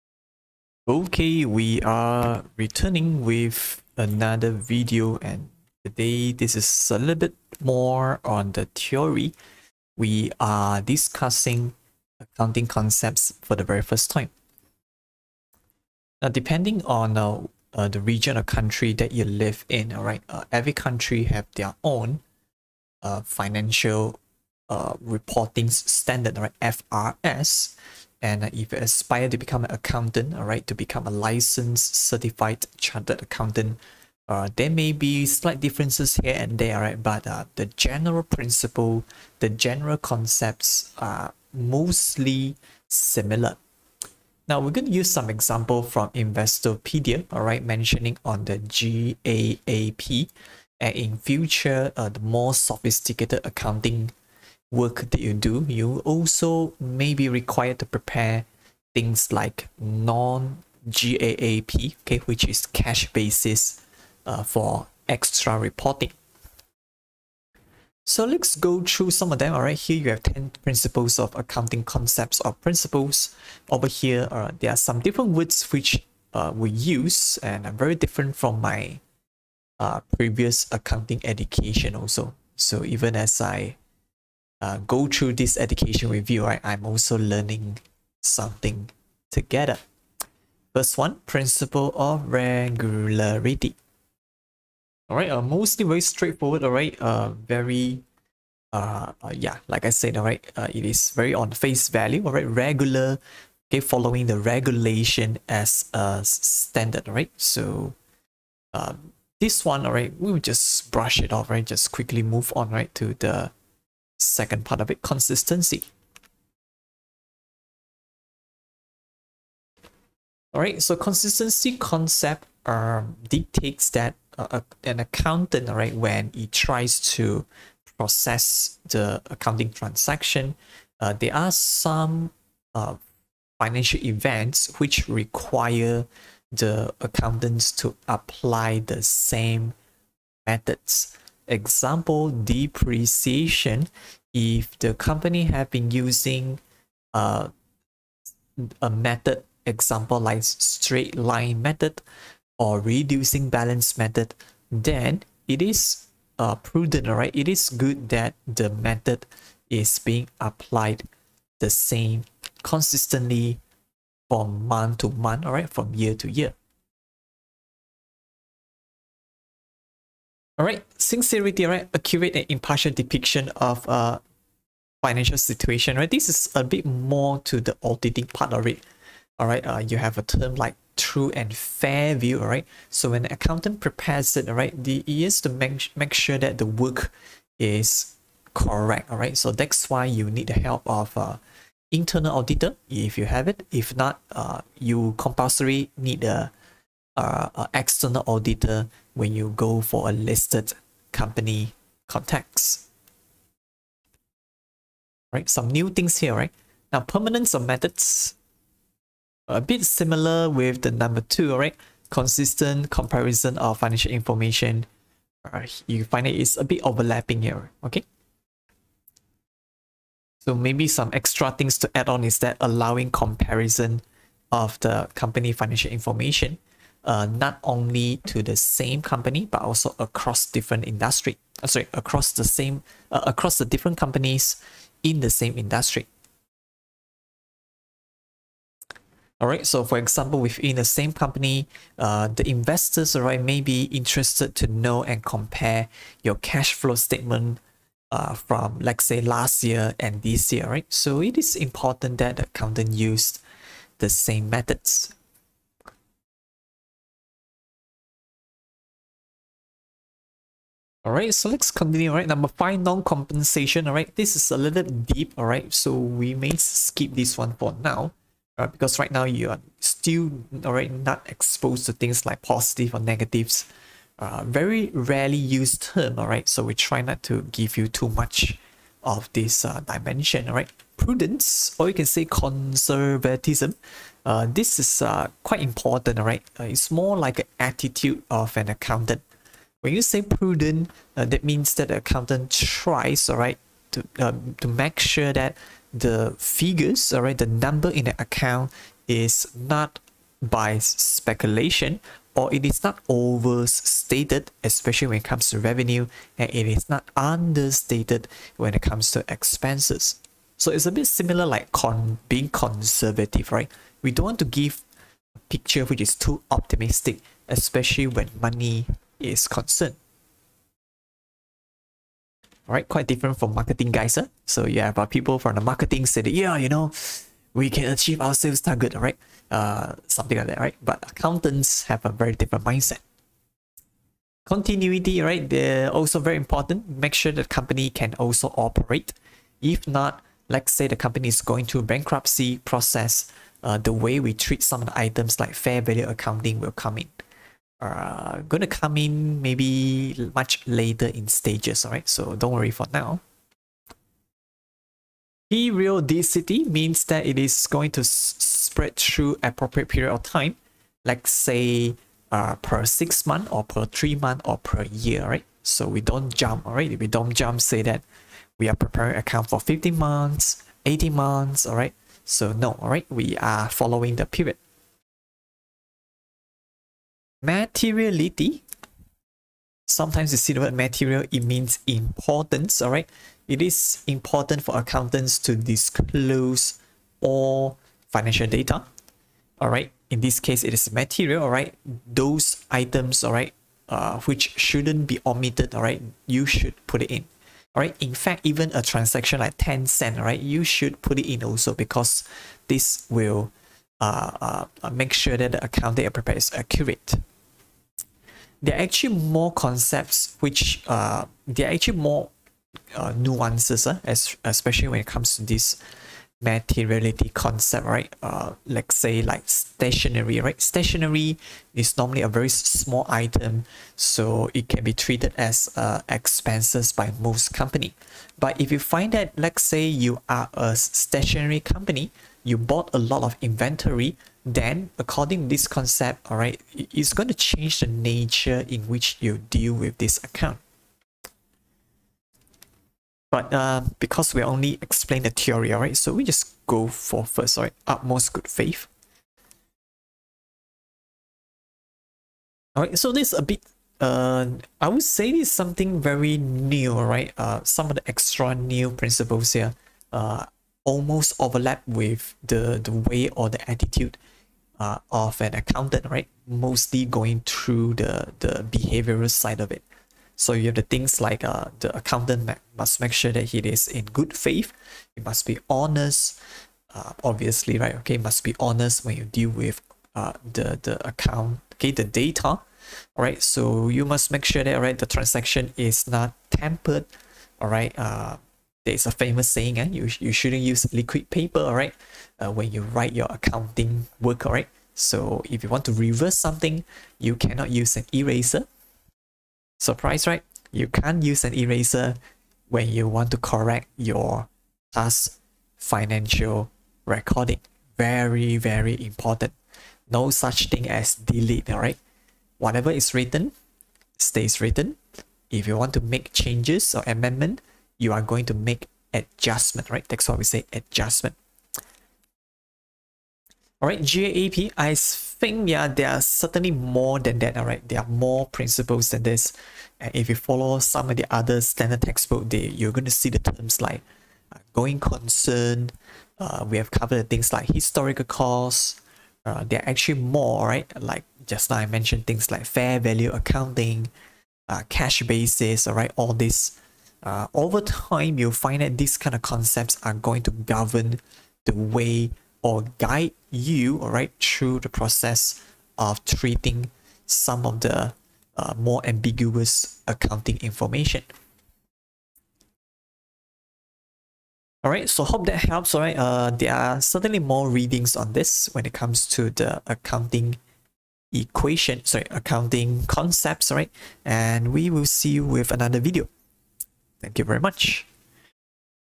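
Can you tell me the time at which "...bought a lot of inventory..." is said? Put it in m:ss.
7:12.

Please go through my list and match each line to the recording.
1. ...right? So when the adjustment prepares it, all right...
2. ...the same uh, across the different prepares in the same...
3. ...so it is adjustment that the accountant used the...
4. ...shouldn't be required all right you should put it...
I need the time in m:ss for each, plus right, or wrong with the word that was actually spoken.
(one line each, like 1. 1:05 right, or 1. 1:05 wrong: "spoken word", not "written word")
1. 3:02 wrong: "accountant", not "adjustment"
2. 3:52 wrong: "companies", not "prepares"
3. 4:10 wrong: "important", not "adjustment"
4. 6:34 wrong: "omitted", not "required".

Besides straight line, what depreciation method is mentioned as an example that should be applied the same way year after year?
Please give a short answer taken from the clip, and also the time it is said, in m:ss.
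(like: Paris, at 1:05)
reducing balance method, at 2:32.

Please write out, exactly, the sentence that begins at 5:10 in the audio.
So it's a bit similar like con being conservative, right?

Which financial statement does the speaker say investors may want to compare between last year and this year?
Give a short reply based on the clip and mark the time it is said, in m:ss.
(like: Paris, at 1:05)
cash flow statement, at 4:06.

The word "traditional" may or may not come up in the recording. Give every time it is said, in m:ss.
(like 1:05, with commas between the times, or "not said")
not said.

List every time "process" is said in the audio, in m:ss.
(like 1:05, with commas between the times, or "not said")
2:07, 5:42, 9:14.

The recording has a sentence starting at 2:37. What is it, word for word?
It is good that the method is being applied the same consistently from month to month, all right, from year to year.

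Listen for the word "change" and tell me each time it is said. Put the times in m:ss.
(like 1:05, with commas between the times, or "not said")
7:17, 8:36.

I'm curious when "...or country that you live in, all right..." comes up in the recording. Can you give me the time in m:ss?
0:18.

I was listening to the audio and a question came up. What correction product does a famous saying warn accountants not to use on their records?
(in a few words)
liquid paper.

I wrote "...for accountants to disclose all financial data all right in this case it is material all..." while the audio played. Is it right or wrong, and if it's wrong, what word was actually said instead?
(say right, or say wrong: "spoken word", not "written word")
right.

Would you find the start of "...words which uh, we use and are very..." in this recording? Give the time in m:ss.
1:15.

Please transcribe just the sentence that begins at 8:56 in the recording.
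Uh, we have covered things like historical costs.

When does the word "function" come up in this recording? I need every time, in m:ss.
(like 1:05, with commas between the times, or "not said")
not said.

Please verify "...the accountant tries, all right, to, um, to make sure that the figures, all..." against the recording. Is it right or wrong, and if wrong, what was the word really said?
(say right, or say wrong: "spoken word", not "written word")
right.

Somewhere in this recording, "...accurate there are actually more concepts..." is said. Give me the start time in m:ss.
6:46.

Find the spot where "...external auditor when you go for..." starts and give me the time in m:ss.
3:17.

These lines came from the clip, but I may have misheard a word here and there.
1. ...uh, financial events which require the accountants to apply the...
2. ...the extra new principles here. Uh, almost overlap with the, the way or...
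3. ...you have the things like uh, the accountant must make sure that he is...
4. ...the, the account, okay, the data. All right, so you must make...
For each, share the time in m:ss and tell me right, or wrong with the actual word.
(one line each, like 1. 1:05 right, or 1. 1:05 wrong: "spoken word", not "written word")
1. 2:12 right
2. 7:37 right
3. 7:50 right
4. 8:00 right.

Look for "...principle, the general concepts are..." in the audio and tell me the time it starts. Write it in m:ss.
0:38.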